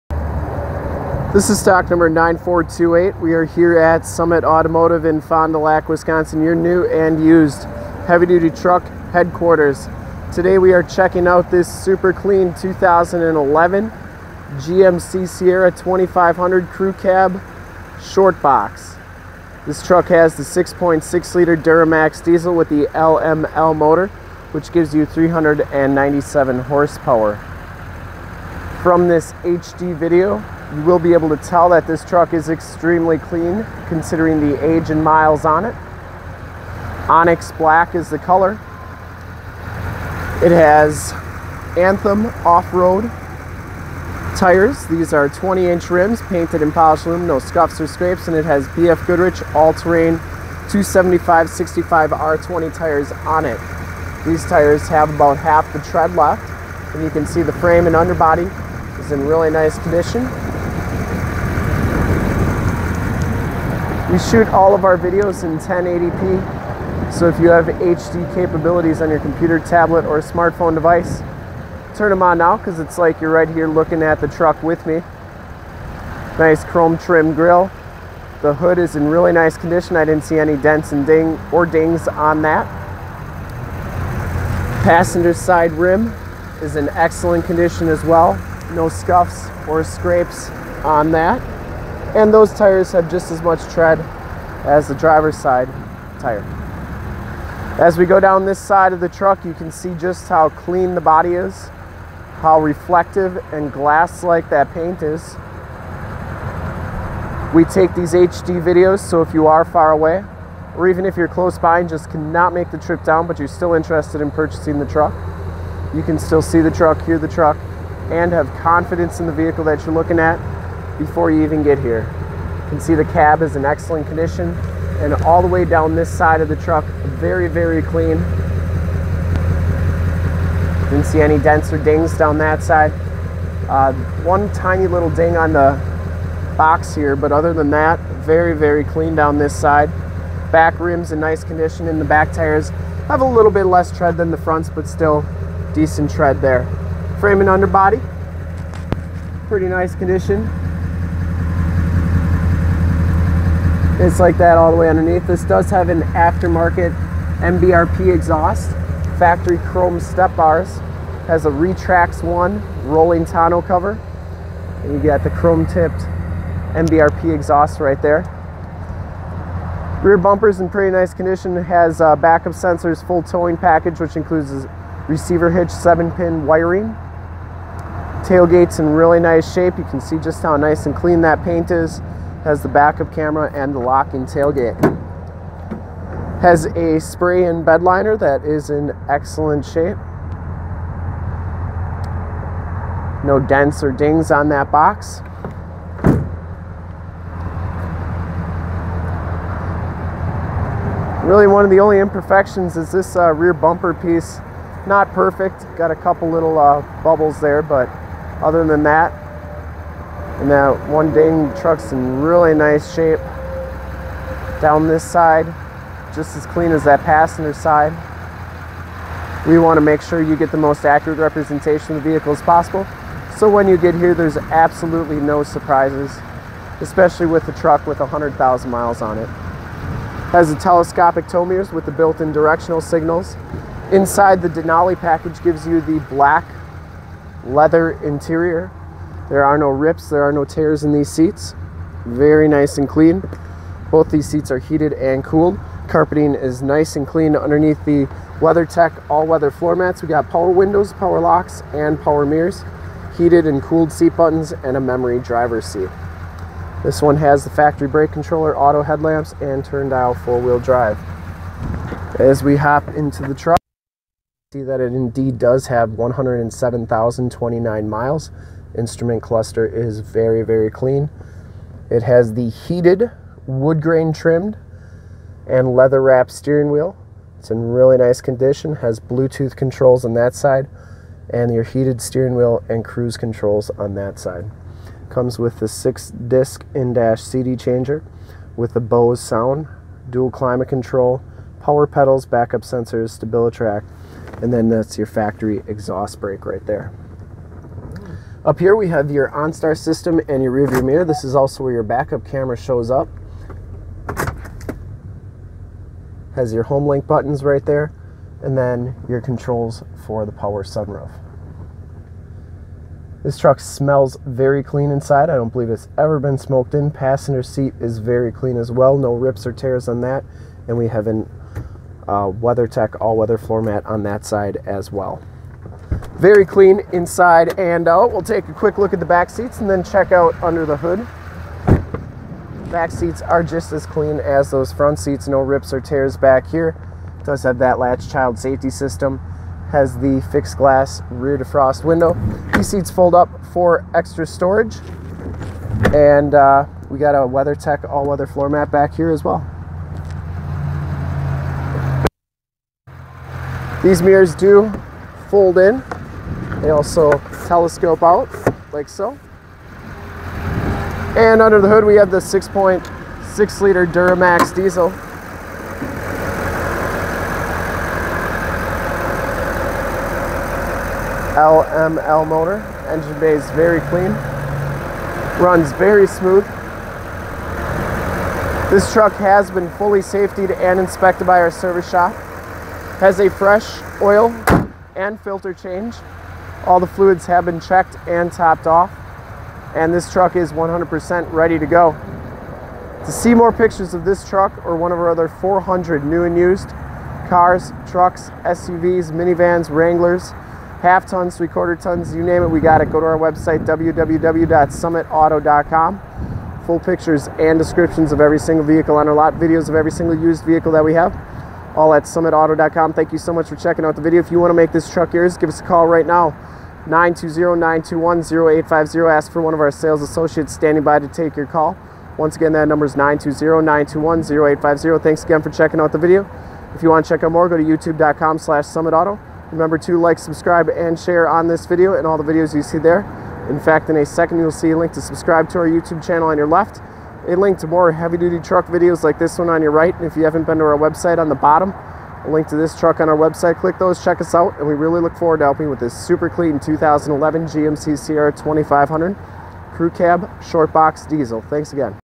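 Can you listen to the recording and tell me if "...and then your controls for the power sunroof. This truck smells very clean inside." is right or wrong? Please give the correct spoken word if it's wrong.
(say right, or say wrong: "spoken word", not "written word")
right.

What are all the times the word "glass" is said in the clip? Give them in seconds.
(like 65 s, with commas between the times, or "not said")
103 s, 340 s.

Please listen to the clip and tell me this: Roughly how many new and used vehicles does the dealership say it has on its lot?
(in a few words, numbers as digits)
400.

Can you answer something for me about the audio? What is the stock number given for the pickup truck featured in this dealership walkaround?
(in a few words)
9428.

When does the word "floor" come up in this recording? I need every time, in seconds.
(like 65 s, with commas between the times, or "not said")
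249 s, 323 s, 348 s.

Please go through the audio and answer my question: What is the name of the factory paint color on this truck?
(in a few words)
Onyx black.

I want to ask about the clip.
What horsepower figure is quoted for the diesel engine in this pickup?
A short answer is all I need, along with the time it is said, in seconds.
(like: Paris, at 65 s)
397, at 25 s.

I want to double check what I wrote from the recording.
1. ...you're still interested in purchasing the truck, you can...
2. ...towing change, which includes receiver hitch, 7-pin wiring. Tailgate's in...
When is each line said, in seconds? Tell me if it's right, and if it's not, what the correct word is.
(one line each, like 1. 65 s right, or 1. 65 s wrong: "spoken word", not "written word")
1. 113 s right
2. 173 s wrong: "package", not "change".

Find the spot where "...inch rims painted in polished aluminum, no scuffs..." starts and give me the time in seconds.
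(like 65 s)
45 s.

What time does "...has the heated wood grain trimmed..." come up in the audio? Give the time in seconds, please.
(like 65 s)
272 s.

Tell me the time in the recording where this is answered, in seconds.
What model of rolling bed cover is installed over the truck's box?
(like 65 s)
161 s.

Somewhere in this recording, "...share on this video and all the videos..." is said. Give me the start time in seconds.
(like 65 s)
430 s.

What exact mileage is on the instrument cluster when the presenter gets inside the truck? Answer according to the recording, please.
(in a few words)
107,029.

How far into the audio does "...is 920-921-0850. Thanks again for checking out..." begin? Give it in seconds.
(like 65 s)
422 s.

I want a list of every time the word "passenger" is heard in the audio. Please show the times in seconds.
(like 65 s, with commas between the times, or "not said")
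84 s, 217 s, 316 s.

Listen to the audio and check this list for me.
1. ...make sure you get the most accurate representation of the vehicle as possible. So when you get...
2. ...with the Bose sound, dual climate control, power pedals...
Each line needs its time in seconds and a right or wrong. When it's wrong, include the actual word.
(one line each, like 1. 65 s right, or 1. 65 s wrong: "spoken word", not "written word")
1. 219 s right
2. 288 s right.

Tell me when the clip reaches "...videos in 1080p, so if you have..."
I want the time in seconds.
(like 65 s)
64 s.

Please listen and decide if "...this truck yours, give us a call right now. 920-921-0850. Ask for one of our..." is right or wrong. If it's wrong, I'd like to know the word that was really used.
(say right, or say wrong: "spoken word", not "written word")
right.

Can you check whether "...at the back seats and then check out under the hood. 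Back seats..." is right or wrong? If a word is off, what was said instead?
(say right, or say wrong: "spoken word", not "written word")
right.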